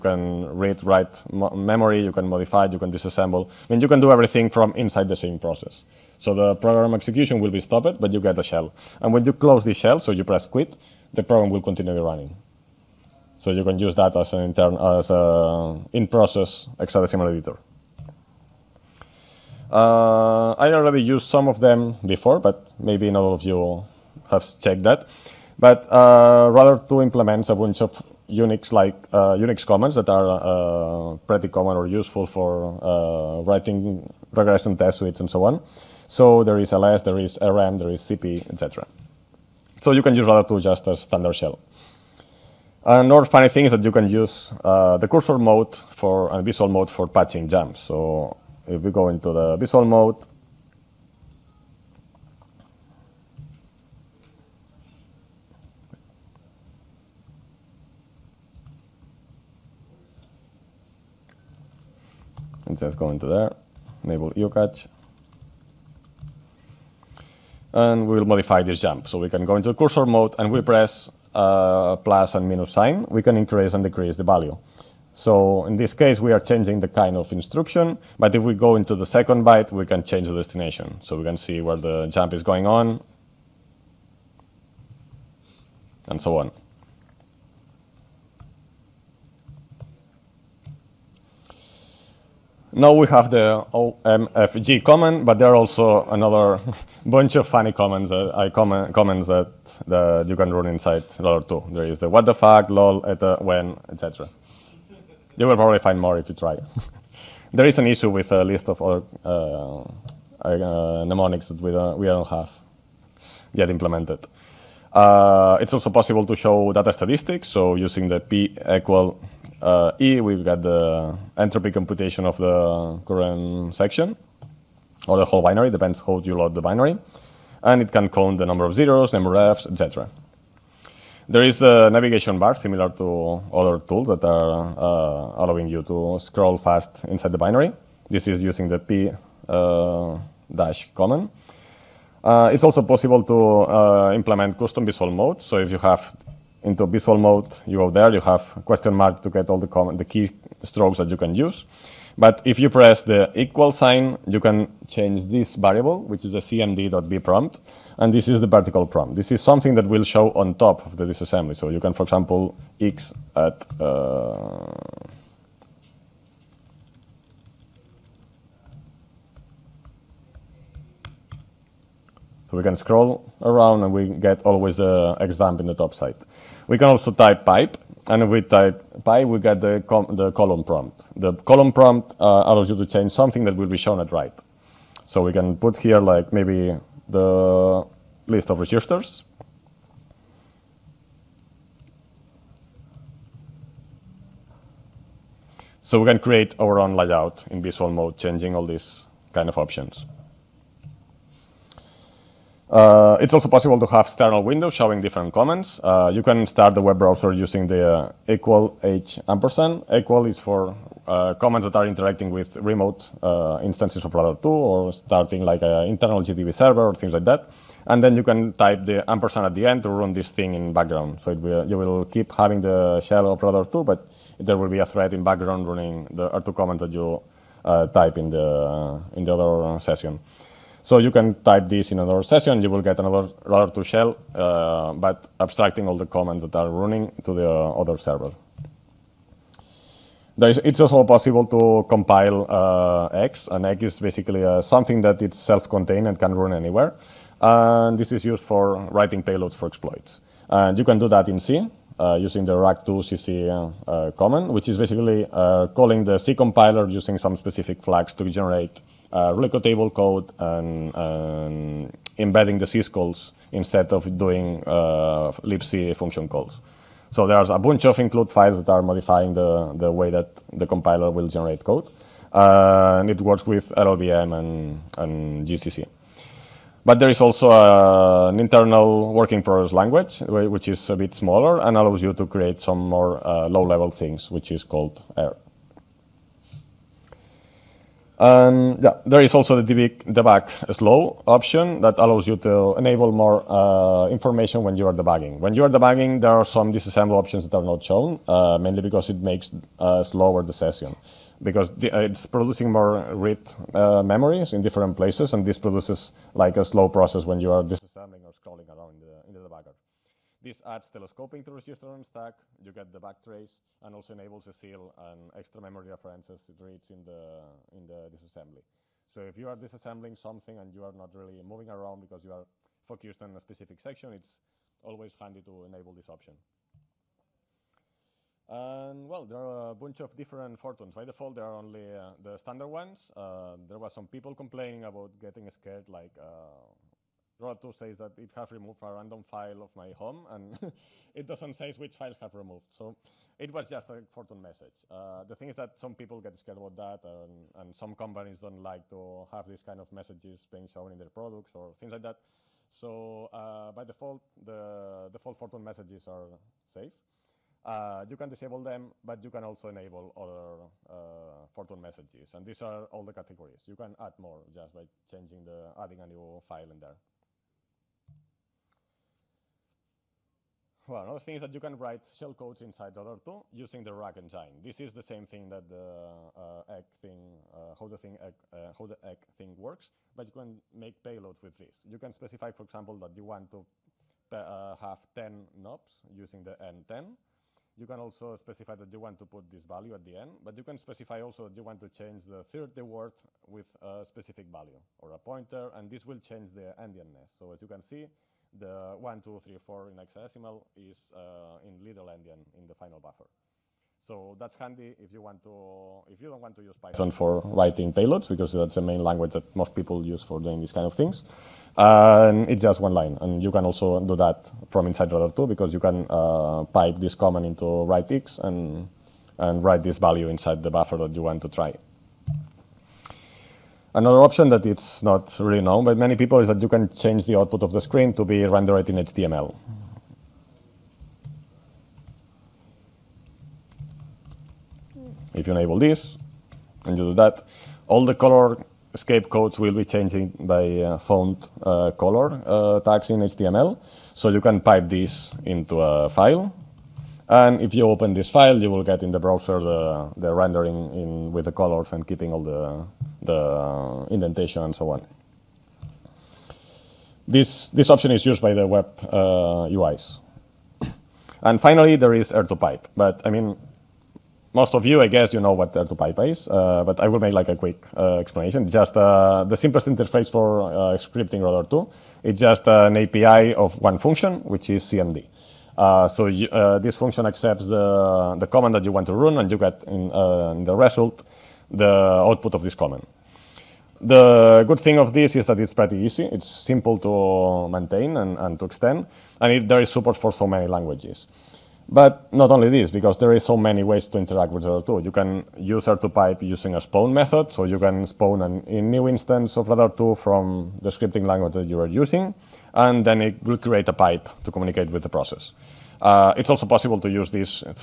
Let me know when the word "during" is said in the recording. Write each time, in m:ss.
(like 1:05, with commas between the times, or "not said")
not said.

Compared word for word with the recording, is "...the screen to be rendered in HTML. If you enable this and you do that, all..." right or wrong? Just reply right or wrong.
right.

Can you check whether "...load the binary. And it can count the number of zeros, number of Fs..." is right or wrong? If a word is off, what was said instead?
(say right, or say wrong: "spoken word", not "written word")
right.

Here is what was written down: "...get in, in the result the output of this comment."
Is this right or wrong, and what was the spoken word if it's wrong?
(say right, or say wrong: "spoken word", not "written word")
right.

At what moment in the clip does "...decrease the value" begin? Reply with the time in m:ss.
1:13.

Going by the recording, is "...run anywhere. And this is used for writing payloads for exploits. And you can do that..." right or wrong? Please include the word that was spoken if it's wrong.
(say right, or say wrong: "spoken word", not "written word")
right.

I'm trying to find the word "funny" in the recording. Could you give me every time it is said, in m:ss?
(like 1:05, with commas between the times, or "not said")
0:43, 1:37.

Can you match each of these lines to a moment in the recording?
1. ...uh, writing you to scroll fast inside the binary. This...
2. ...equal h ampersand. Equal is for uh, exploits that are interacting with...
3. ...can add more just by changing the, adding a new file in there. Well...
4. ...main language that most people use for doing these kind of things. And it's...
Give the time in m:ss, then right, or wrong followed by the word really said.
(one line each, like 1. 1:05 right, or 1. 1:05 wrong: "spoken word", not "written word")
1. 2:14 wrong: "allowing", not "writing"
2. 3:28 wrong: "comments", not "exploits"
3. 6:03 right
4. 6:48 right.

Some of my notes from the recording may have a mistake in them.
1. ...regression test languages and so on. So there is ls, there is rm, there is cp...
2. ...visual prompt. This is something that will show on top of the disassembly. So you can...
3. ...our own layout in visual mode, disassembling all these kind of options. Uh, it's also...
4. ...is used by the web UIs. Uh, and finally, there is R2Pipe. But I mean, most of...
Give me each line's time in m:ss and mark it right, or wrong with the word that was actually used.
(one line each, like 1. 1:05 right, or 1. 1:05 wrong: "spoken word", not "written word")
1. 0:34 wrong: "suites", not "languages"
2. 2:38 wrong: "vertical", not "visual"
3. 3:16 wrong: "changing", not "disassembling"
4. 7:38 right.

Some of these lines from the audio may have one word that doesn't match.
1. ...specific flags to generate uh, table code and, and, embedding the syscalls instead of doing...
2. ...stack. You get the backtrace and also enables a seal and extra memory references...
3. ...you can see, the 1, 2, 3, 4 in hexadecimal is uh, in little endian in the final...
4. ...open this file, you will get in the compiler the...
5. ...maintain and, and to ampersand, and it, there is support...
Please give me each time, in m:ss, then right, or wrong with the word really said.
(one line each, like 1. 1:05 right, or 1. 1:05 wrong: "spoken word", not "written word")
1. 4:17 right
2. 5:12 right
3. 6:37 right
4. 7:27 wrong: "browser", not "compiler"
5. 8:07 wrong: "extend", not "ampersand".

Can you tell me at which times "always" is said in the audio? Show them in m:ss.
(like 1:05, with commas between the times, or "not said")
2:54, 5:24.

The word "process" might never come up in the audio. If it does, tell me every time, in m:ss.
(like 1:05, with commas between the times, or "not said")
0:05, 0:15, 5:06, 8:25.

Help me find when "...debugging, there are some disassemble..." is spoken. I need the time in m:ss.
4:55.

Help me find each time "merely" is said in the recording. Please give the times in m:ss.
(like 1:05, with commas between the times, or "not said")
not said.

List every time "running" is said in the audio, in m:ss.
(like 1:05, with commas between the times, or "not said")
0:12, 3:45, 3:56.